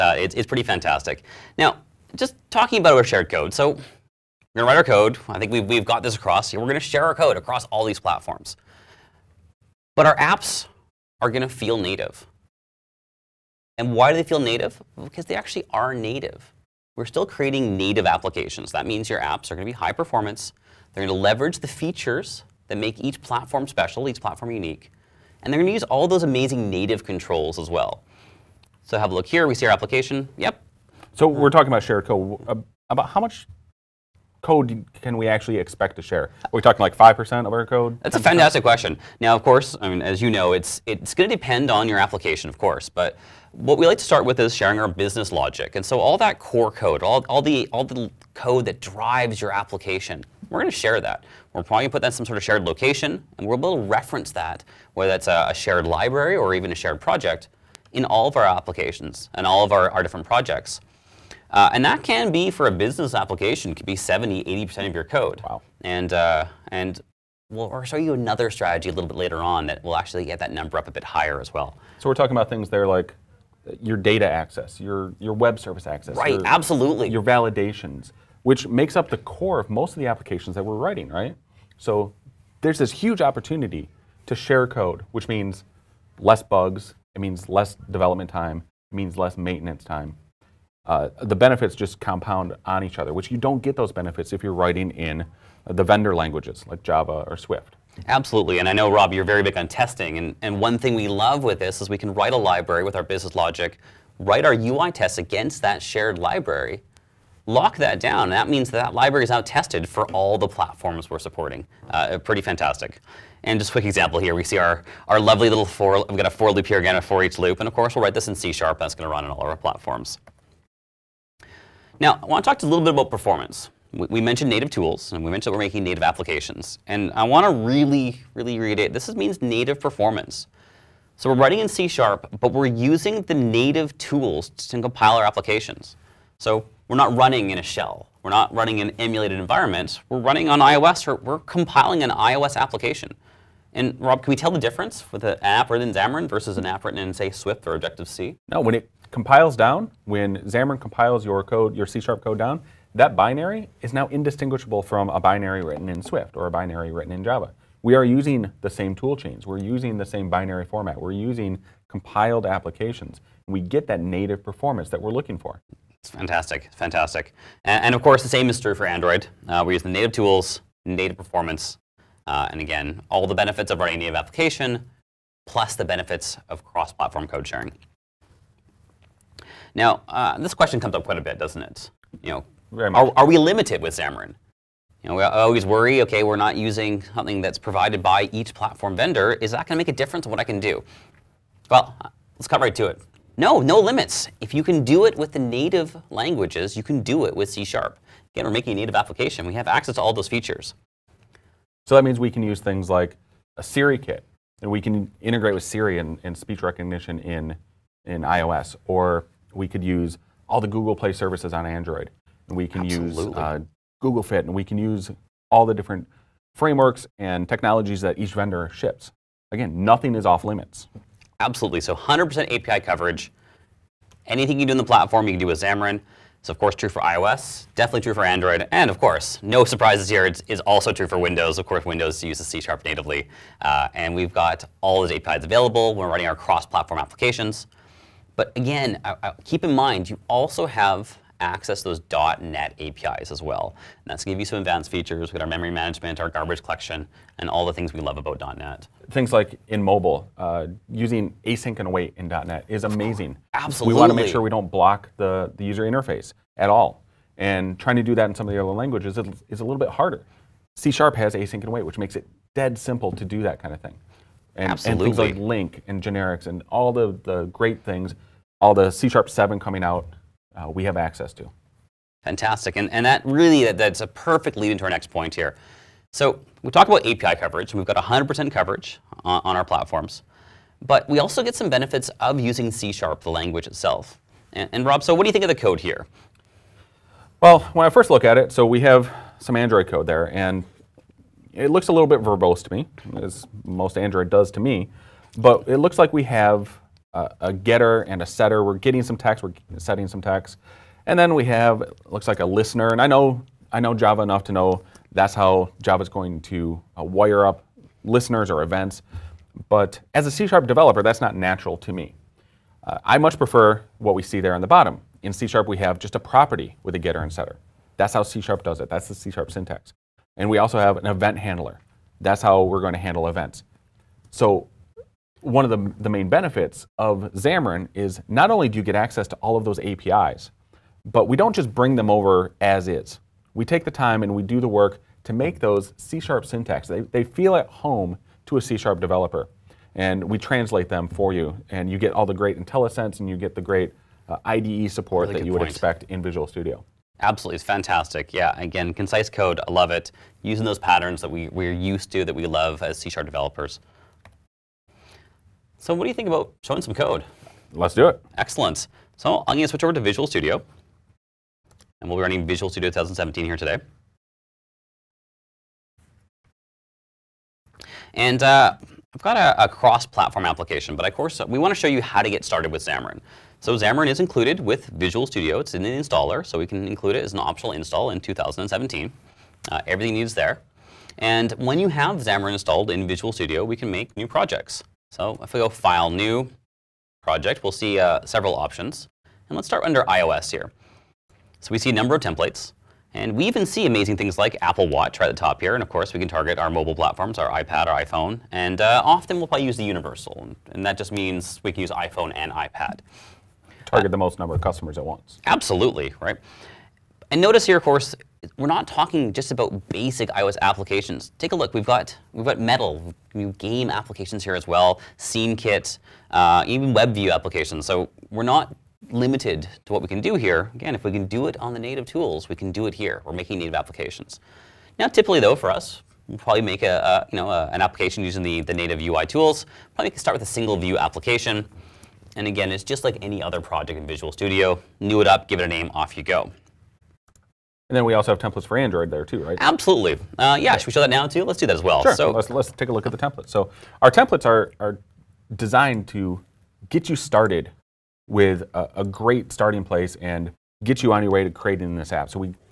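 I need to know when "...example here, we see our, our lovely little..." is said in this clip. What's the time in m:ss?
1:53.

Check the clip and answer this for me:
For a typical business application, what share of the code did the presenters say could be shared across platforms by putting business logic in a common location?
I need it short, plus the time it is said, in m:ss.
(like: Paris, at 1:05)
70-80%, at 1:03.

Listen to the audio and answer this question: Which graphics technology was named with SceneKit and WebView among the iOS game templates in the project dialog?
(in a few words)
Metal.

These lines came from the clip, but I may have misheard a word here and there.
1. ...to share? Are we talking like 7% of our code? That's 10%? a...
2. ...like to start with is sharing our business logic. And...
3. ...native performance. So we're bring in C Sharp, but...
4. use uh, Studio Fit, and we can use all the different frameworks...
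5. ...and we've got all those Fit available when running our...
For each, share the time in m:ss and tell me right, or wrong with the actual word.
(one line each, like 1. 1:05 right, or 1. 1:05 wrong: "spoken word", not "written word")
1. 0:35 wrong: "5", not "7"
2. 0:43 right
3. 2:09 wrong: "writing", not "bring"
4. 3:33 wrong: "Google", not "Studio"
5. 3:53 wrong: "APIs", not "Fit".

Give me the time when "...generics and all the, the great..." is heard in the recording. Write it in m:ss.
4:26.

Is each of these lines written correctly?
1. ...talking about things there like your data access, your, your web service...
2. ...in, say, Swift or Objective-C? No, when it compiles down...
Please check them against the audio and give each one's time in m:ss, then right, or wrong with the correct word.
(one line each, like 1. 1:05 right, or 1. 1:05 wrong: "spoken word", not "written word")
1. 1:12 right
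2. 2:26 right.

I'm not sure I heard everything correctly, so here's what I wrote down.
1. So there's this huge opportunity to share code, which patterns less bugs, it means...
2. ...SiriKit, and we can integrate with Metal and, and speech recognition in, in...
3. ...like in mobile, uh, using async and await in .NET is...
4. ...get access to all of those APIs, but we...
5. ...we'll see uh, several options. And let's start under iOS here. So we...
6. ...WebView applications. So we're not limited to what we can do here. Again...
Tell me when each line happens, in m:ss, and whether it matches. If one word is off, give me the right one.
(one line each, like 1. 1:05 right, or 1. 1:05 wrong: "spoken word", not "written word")
1. 1:21 wrong: "means", not "patterns"
2. 3:23 wrong: "Siri", not "Metal"
3. 4:09 right
4. 5:28 right
5. 6:27 right
6. 6:56 right.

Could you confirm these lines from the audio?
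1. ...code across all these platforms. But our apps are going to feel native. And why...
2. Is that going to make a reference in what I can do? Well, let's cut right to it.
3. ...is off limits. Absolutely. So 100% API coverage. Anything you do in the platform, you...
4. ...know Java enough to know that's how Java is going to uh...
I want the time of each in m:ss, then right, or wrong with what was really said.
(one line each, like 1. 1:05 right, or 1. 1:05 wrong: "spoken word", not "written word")
1. 0:07 right
2. 3:09 wrong: "difference", not "reference"
3. 3:40 right
4. 5:03 right.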